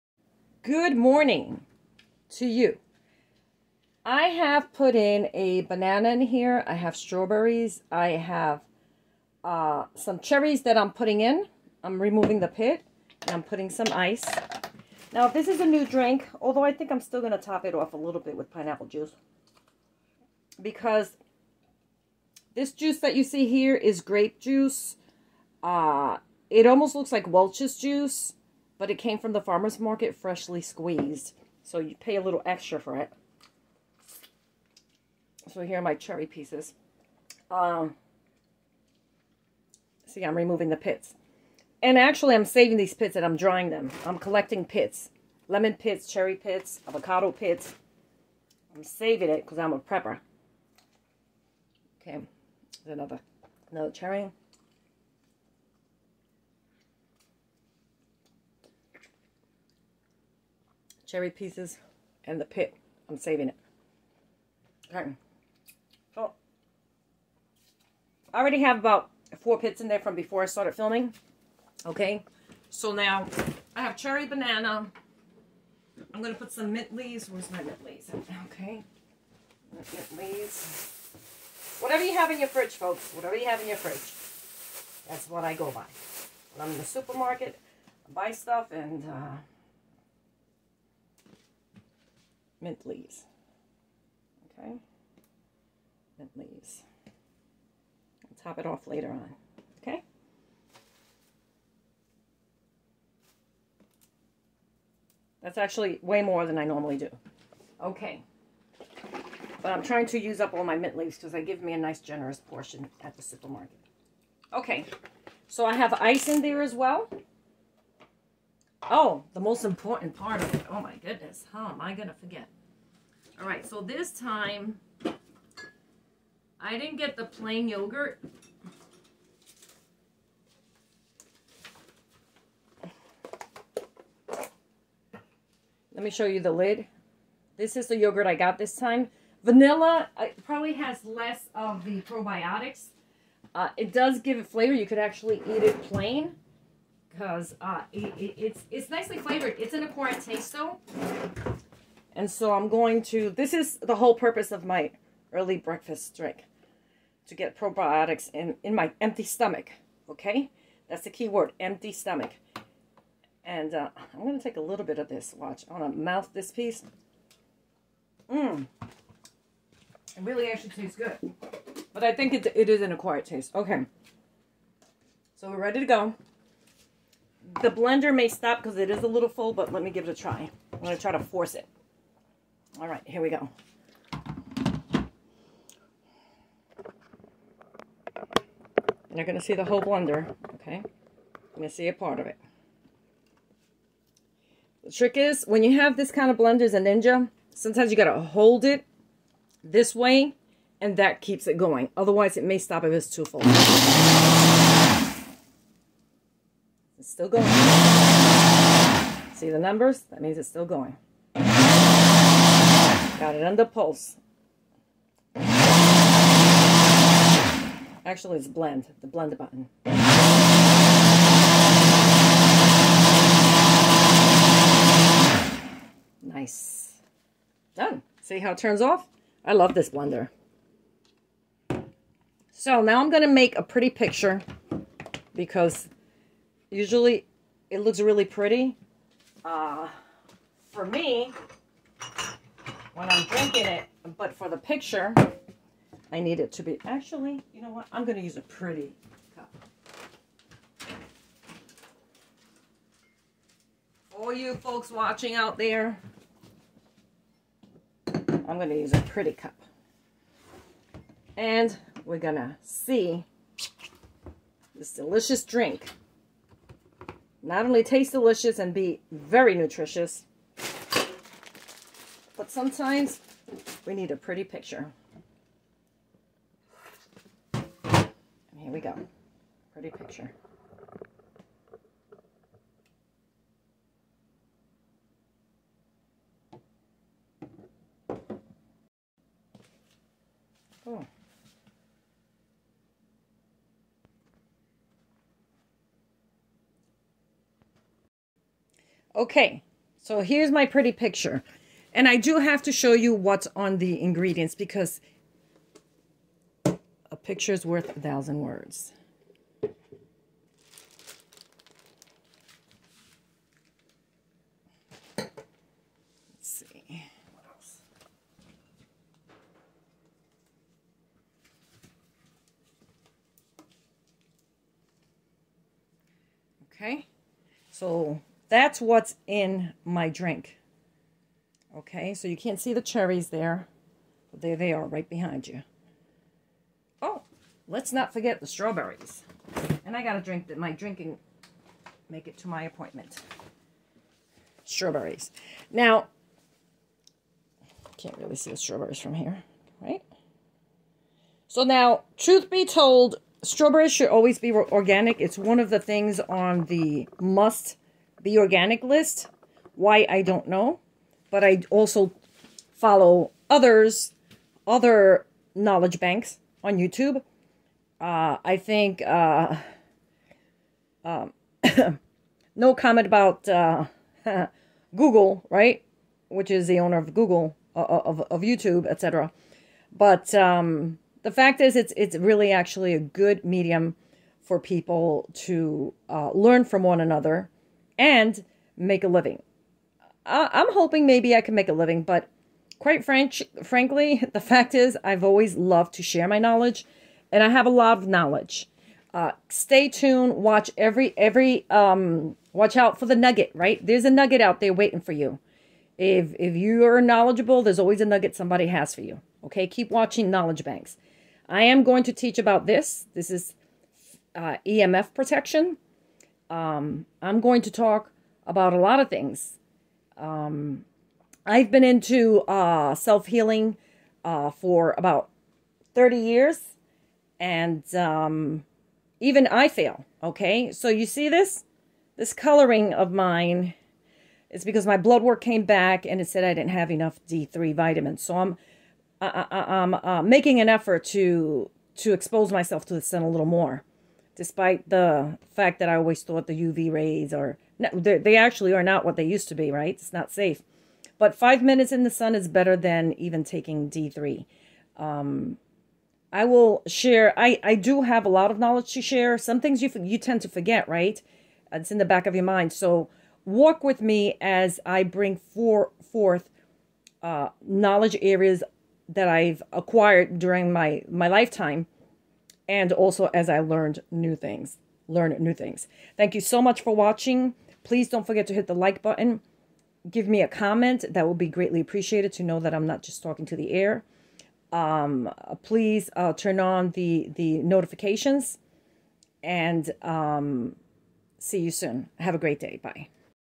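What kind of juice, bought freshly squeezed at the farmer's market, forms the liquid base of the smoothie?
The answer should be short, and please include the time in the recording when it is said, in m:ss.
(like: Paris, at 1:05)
grape juice, at 0:24.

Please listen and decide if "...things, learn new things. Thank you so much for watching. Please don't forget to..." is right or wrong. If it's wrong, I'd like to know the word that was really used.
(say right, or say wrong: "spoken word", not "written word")
right.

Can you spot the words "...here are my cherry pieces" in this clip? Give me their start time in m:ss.
0:35.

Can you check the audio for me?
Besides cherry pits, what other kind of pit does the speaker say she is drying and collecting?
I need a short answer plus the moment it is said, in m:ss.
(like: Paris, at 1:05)
lemon, at 0:45.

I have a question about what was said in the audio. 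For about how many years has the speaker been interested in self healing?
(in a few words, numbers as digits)
30 years.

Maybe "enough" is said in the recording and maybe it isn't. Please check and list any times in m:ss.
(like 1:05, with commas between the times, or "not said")
7:16.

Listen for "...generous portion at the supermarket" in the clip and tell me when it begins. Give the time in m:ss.
1:51.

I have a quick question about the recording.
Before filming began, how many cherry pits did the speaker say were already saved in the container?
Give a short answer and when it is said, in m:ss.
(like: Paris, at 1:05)
4, at 1:09.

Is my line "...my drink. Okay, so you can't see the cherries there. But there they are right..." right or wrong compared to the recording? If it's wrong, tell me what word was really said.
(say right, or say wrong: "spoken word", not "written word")
right.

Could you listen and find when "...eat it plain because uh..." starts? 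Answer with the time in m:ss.
2:25.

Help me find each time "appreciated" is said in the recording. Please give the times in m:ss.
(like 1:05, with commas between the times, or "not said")
8:01.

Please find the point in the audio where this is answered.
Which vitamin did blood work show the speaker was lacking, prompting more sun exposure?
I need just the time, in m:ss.
7:17.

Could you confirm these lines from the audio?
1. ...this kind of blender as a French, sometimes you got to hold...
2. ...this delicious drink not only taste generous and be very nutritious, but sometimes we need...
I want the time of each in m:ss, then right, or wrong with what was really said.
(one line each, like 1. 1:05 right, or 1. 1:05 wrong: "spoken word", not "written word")
1. 3:15 wrong: "Ninja", not "French"
2. 4:24 wrong: "delicious", not "generous".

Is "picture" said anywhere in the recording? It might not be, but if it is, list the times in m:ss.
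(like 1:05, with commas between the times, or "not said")
3:53, 4:04, 4:34, 4:39, 5:00, 5:07.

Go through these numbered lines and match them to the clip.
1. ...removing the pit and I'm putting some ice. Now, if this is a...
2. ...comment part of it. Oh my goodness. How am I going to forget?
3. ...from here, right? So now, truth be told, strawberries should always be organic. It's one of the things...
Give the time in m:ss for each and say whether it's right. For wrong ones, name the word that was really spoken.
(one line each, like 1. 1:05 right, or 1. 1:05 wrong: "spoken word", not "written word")
1. 0:11 right
2. 1:59 wrong: "important", not "comment"
3. 5:48 right.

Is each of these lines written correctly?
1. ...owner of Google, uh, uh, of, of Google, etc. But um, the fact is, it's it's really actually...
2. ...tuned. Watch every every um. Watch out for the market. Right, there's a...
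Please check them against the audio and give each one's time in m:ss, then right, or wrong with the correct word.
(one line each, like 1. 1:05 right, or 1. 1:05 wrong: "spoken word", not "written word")
1. 6:16 wrong: "YouTube", not "Google"
2. 6:39 wrong: "nugget", not "market".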